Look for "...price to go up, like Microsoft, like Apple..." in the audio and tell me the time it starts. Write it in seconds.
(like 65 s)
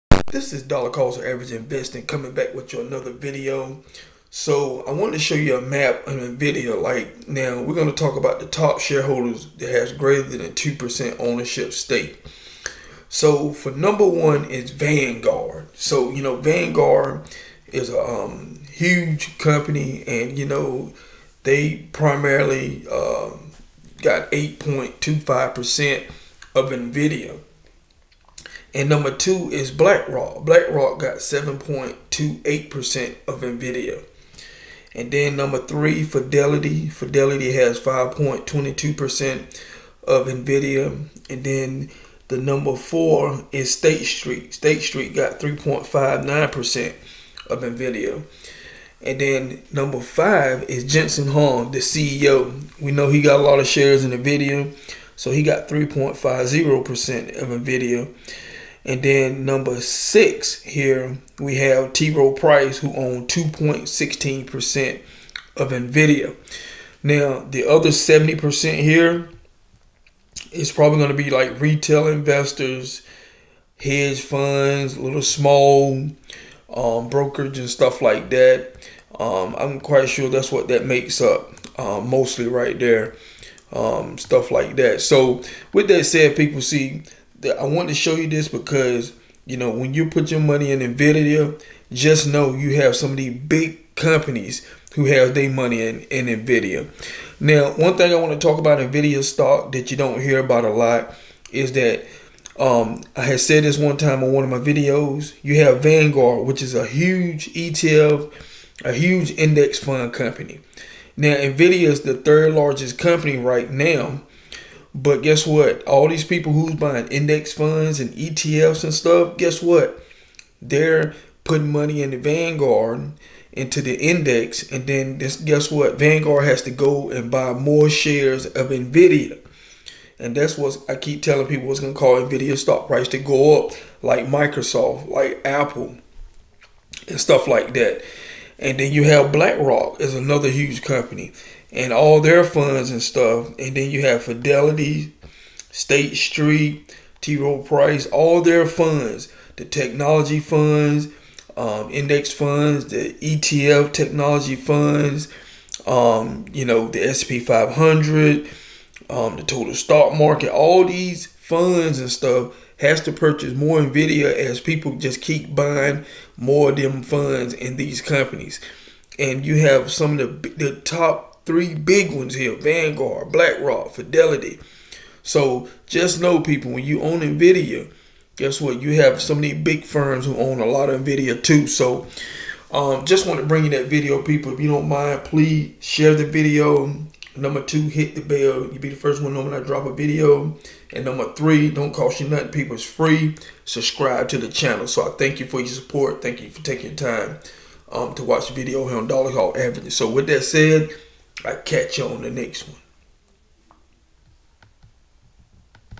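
132 s.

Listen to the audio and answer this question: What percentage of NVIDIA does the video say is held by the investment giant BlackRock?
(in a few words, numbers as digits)
7.28%.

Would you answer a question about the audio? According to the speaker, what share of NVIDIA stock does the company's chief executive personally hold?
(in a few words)
3.50%.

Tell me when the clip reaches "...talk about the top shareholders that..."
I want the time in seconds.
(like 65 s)
8 s.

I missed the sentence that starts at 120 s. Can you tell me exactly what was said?
They're putting money in the Vanguard into the index, and then this, guess what?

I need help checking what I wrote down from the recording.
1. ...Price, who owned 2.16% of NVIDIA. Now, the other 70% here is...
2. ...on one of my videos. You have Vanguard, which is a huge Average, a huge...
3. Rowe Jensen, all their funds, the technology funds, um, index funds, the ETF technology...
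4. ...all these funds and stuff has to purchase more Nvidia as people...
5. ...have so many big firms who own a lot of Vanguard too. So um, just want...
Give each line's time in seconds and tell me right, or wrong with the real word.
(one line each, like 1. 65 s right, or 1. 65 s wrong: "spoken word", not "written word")
1. 62 s right
2. 104 s wrong: "ETF", not "Average"
3. 147 s wrong: "Price", not "Jensen"
4. 160 s right
5. 179 s wrong: "NVIDIA", not "Vanguard".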